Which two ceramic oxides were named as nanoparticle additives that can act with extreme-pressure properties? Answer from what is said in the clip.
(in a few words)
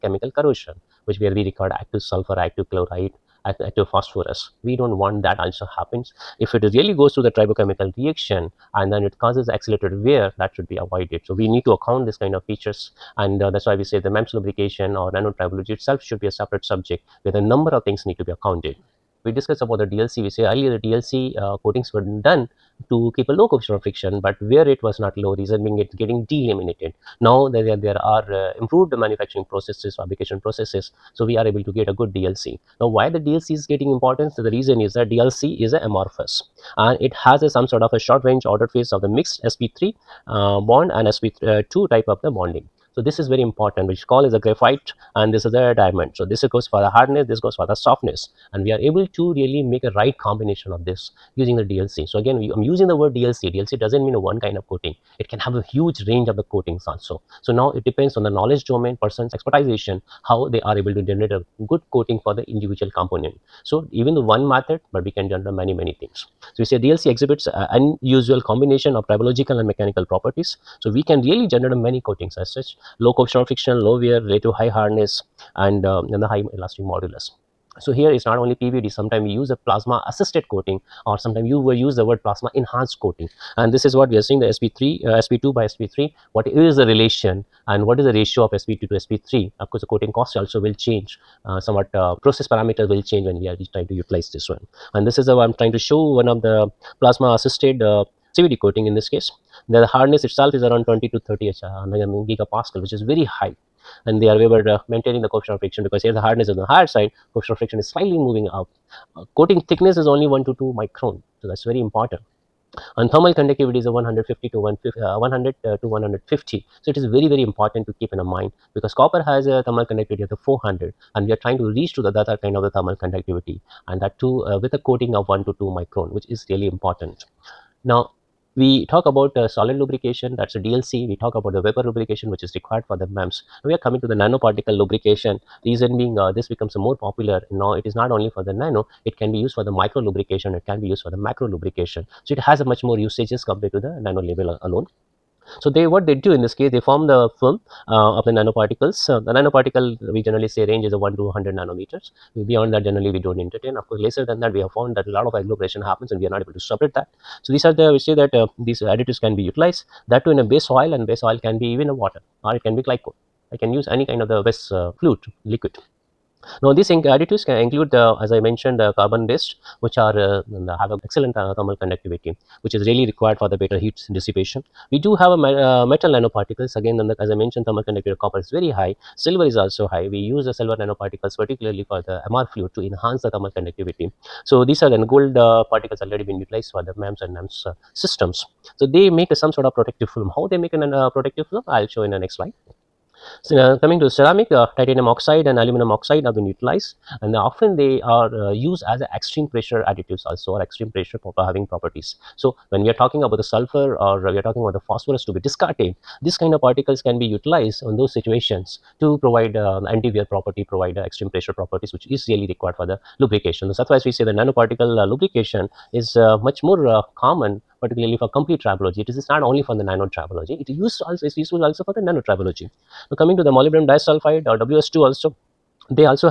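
titanium oxide and aluminum oxide.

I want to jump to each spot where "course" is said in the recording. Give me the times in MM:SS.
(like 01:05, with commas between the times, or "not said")
01:29, 02:33.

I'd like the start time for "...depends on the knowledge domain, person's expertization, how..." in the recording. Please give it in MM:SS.
00:57.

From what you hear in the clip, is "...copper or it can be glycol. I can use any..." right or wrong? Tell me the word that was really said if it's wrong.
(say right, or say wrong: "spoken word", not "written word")
wrong: "water", not "copper".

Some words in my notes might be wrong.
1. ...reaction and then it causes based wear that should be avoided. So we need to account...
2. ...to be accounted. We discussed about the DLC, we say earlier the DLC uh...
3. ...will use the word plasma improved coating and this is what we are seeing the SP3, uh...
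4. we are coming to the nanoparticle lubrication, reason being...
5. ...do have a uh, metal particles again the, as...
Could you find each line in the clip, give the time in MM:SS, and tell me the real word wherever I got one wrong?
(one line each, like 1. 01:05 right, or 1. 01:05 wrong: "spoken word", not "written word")
1. 00:07 wrong: "accelerated", not "based"
2. 00:18 right
3. 01:21 wrong: "enhanced", not "improved"
4. 02:13 right
5. 02:55 wrong: "nanoparticles", not "particles".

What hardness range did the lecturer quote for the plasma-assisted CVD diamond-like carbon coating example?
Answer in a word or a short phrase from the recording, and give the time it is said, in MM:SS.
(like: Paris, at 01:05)
20 to 30 gigapascal, at 01:40.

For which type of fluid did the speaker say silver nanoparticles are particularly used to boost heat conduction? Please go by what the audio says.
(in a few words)
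MR fluid.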